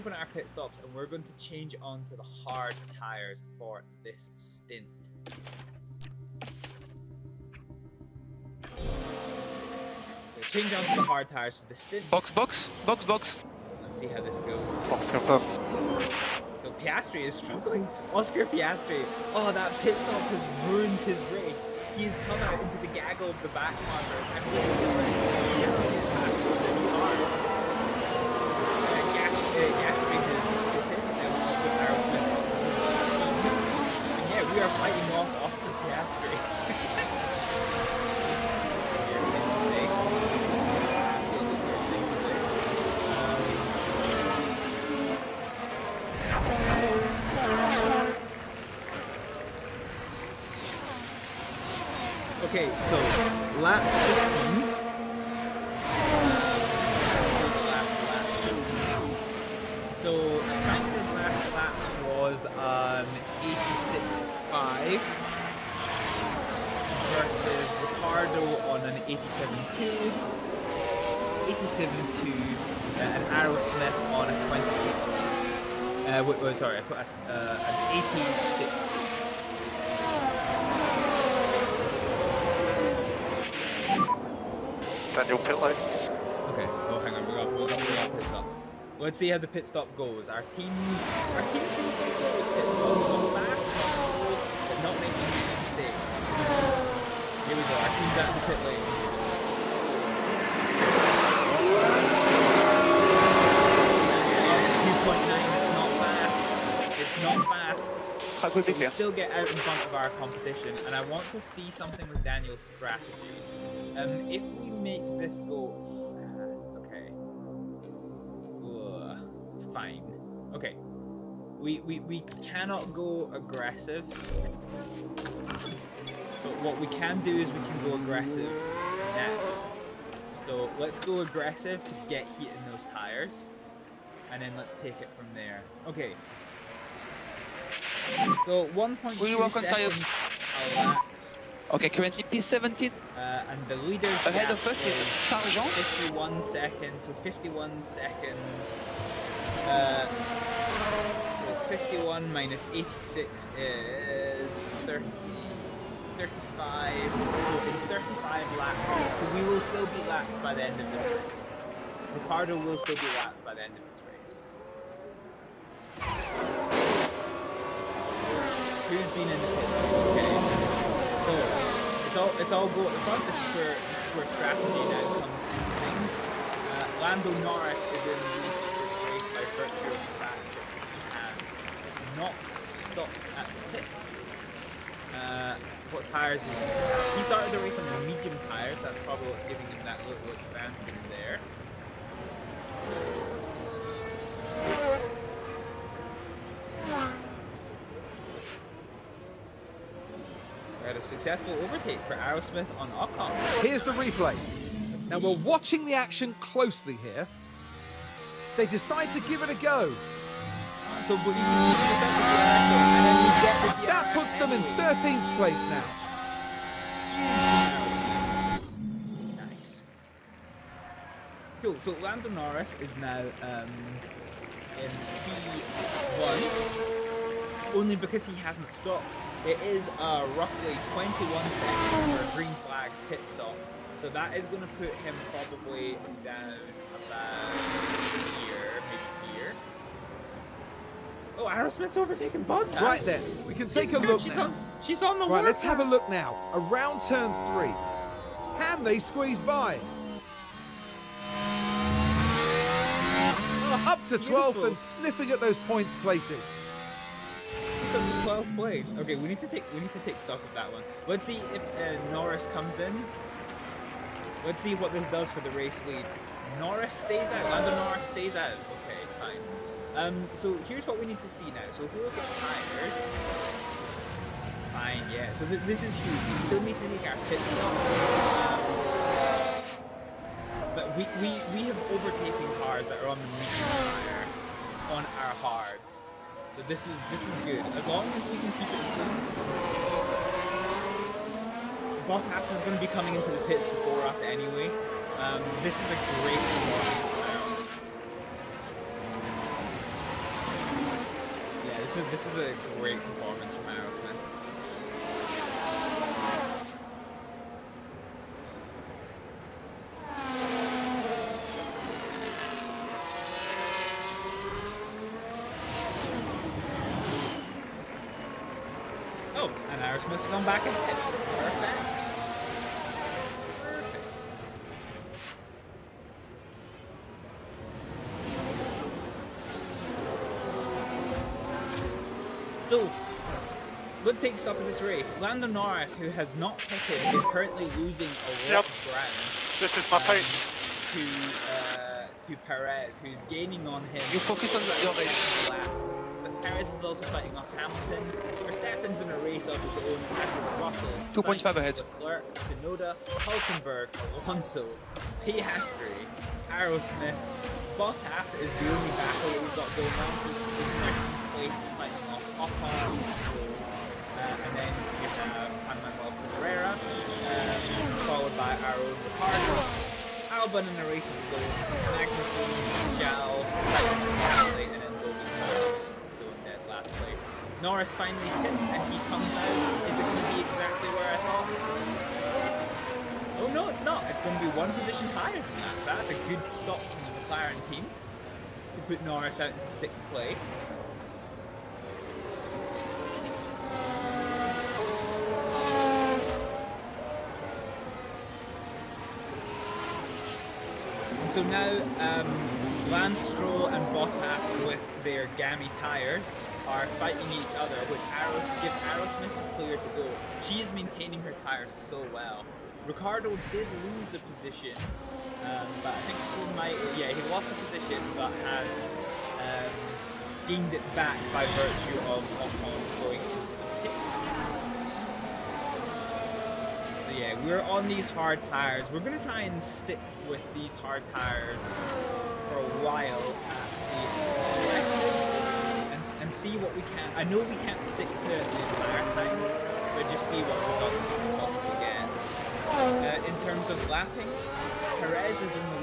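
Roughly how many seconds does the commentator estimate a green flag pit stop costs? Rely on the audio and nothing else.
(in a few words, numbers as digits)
21 seconds.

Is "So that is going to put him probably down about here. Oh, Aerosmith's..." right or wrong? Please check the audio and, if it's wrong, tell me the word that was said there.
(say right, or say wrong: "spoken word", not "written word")
right.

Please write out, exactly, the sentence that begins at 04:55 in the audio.
Um, this is a great reward.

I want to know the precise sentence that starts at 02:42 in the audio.
Ricciardo will still be lapped by the end of this race.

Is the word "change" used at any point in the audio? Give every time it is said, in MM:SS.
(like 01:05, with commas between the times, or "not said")
00:01, 00:10.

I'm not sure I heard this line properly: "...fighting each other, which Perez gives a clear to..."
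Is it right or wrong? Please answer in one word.
wrong.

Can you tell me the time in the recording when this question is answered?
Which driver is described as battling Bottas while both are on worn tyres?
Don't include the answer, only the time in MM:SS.
06:42.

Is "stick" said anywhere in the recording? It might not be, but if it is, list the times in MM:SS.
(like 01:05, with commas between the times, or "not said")
07:09, 07:17.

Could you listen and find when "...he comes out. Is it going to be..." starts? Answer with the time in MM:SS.
06:18.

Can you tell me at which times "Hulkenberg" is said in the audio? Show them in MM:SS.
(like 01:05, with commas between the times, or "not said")
05:53.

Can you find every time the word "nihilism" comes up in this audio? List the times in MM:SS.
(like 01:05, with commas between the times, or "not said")
not said.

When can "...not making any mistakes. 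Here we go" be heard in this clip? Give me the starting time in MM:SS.
01:34.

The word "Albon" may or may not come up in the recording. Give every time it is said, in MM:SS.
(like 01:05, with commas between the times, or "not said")
06:10.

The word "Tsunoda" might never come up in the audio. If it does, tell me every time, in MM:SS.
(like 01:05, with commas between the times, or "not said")
05:52.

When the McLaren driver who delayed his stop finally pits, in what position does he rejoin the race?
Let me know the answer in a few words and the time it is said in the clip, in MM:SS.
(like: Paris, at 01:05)
Sixth, at 06:29.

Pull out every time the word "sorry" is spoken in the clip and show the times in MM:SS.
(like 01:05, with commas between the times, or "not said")
01:16.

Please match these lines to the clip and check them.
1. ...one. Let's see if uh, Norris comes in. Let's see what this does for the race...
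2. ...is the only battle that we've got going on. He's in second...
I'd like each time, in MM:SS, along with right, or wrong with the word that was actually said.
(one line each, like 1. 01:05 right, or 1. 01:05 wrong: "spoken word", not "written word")
1. 04:20 right
2. 05:58 right.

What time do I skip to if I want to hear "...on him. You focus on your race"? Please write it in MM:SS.
05:43.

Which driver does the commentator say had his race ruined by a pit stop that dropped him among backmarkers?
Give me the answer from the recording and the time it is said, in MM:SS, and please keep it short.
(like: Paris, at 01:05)
Oscar Piastri, at 00:18.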